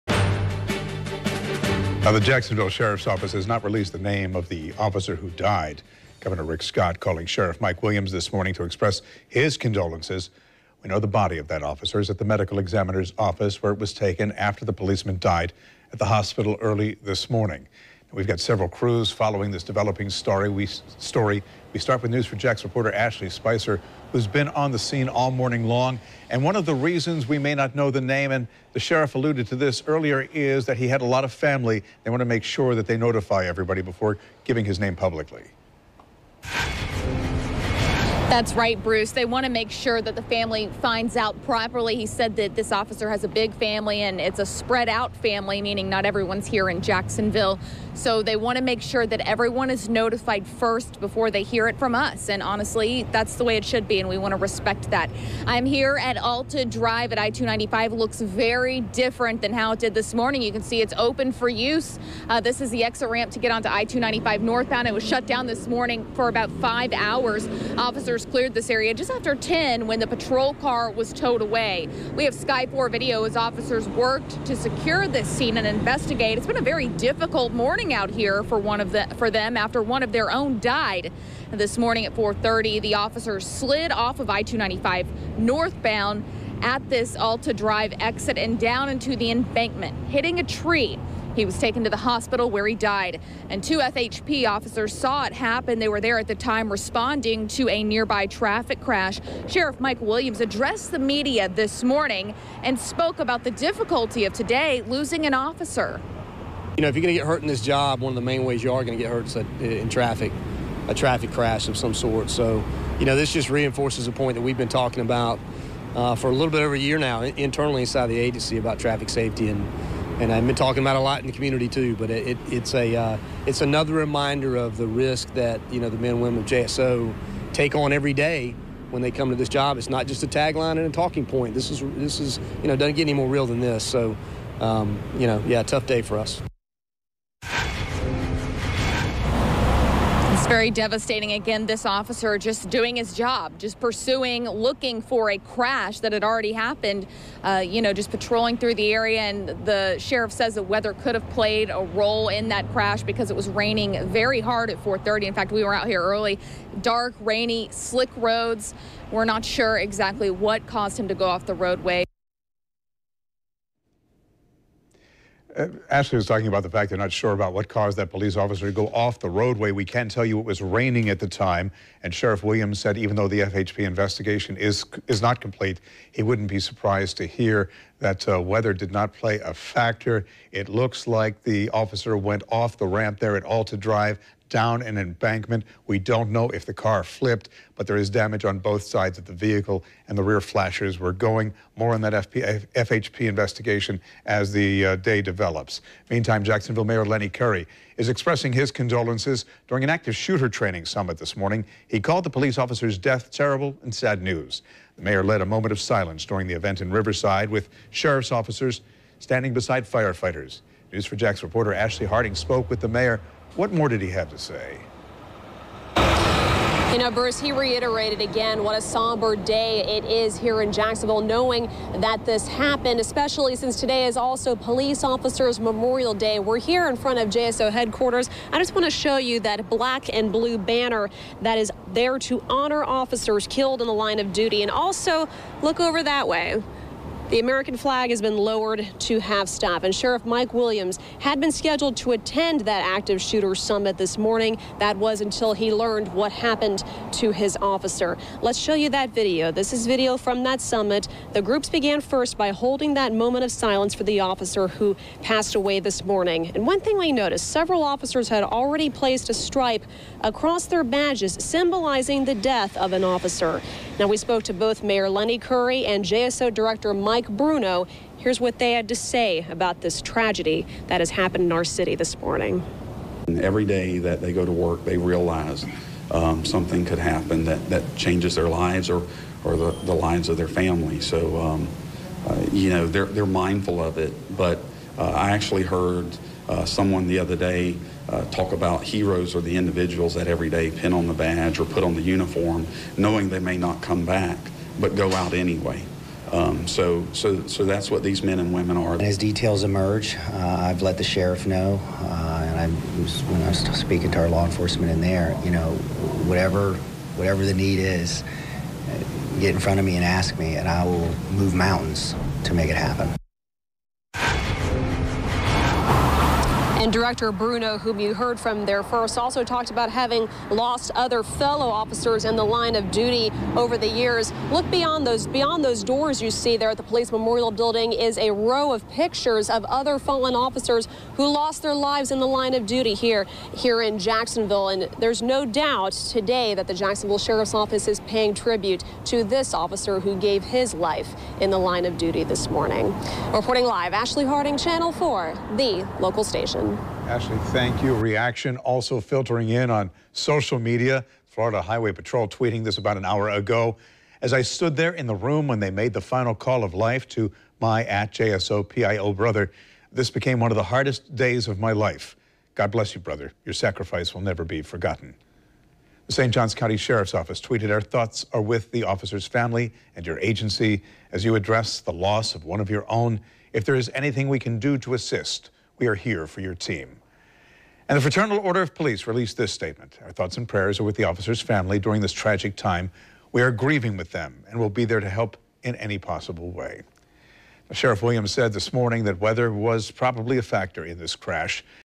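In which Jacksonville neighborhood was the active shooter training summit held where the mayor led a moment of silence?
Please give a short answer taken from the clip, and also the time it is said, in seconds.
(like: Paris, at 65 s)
Riverside, at 206 s.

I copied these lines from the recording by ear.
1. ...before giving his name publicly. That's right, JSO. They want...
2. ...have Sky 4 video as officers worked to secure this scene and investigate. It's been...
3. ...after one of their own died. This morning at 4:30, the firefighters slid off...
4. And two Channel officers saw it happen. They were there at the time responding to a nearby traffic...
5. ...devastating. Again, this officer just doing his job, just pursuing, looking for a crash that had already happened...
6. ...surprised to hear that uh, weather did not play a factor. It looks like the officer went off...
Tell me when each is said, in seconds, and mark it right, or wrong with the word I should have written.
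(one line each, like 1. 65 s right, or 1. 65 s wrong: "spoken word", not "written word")
1. 33 s wrong: "Bruce", not "JSO"
2. 72 s right
3. 79 s wrong: "officers", not "firefighters"
4. 93 s wrong: "FHP", not "Channel"
5. 140 s right
6. 176 s right.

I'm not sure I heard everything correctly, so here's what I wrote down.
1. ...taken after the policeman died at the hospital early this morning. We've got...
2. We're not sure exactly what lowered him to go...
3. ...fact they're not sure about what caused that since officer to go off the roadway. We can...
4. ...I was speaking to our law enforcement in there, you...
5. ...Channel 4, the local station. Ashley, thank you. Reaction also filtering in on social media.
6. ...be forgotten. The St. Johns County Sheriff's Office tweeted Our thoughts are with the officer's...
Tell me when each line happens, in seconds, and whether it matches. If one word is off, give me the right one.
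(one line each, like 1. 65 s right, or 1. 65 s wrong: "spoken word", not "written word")
1. 13 s right
2. 159 s wrong: "caused", not "lowered"
3. 166 s wrong: "police", not "since"
4. 303 s right
5. 344 s right
6. 364 s right.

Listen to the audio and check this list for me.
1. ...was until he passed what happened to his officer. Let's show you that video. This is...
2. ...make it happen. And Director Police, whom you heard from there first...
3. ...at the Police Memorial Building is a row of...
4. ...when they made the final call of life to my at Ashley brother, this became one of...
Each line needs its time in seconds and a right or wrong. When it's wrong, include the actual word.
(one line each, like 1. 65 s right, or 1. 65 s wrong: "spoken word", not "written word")
1. 244 s wrong: "learned", not "passed"
2. 312 s wrong: "Bruno", not "Police"
3. 326 s right
4. 355 s wrong: "JSOPIO", not "Ashley".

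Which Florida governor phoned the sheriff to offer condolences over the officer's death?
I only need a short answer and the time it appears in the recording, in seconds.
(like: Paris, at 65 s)
Rick Scott, at 6 s.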